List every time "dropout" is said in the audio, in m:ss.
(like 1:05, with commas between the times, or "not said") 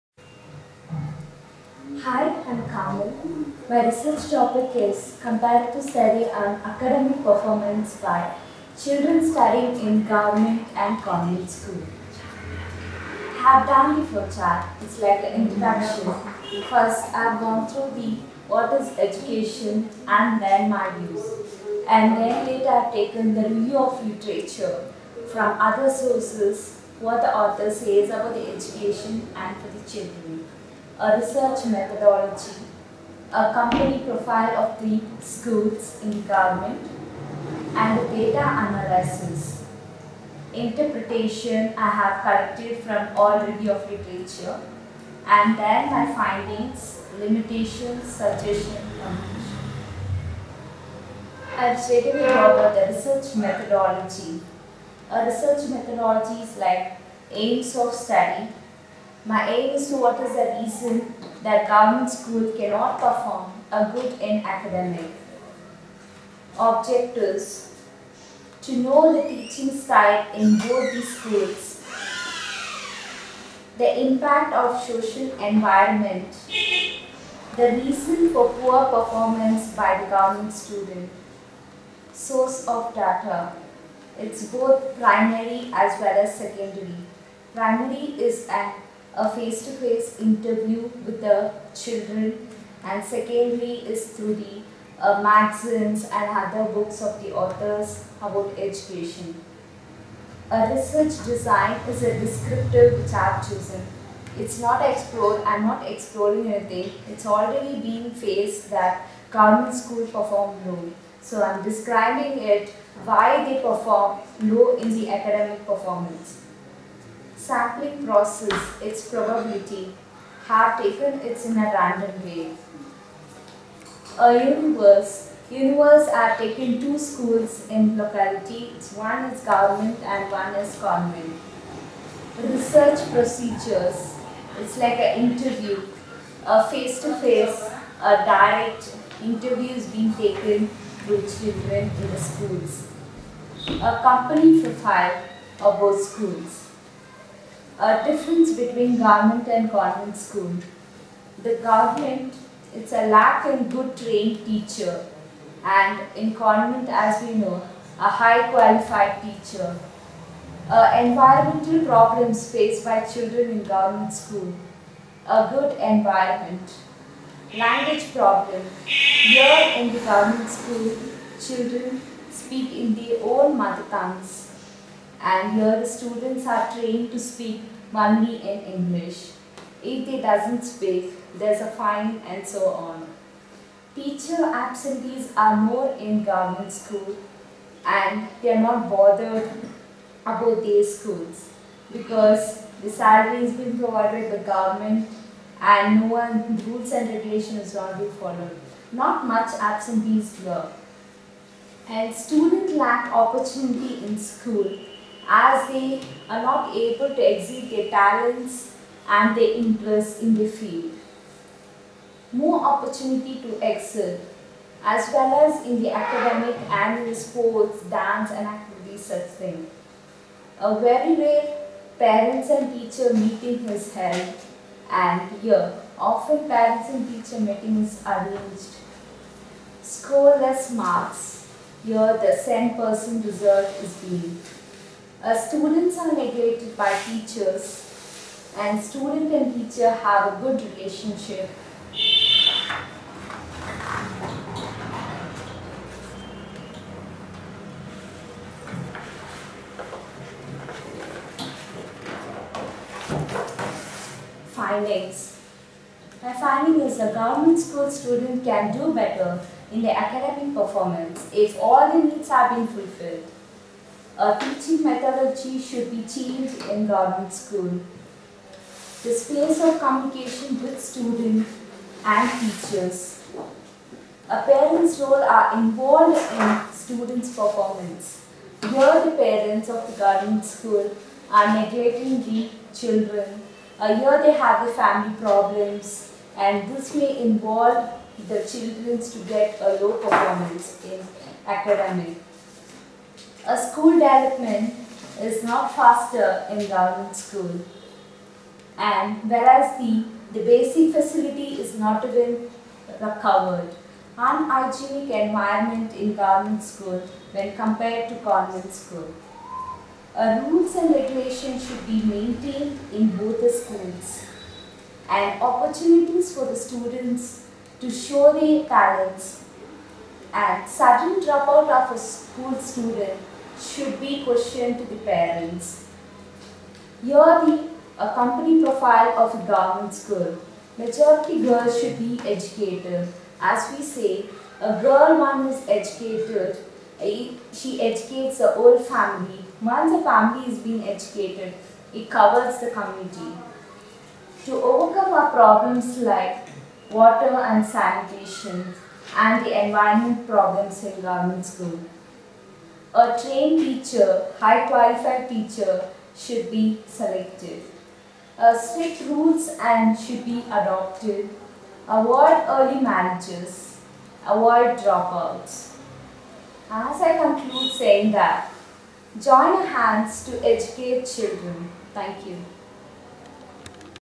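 5:21, 6:04.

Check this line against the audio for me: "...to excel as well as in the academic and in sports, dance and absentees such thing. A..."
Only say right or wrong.
wrong.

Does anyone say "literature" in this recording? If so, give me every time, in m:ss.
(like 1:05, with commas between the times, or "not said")
0:24, 0:43.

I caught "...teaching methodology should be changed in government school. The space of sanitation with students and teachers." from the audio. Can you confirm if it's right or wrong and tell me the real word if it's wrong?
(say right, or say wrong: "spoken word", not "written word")
wrong: "communication", not "sanitation".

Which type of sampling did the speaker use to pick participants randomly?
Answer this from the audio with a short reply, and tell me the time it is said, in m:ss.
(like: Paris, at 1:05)
Probability, at 1:59.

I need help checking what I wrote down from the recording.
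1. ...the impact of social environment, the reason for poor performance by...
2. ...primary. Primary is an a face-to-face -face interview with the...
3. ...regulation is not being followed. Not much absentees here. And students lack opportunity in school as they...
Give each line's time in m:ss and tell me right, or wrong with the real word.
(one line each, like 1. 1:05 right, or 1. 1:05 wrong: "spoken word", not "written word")
1. 1:13 right
2. 1:26 wrong: "secondary", not "primary"
3. 3:17 right.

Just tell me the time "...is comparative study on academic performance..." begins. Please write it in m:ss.
0:04.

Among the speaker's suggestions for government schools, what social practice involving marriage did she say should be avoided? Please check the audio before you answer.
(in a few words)
Early marriages.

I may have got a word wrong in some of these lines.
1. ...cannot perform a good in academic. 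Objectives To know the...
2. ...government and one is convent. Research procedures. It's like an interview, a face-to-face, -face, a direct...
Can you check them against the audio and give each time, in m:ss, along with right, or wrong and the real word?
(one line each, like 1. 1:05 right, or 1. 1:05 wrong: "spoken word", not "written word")
1. 1:02 right
2. 2:09 right.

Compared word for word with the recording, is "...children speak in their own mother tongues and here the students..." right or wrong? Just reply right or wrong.
right.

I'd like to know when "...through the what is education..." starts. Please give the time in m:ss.
0:17.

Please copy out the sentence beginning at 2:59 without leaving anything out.
If they doesn't speak, there's a fine and so on.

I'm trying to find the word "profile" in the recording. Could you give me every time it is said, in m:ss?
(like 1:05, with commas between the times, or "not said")
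0:34, 2:24, 5:28.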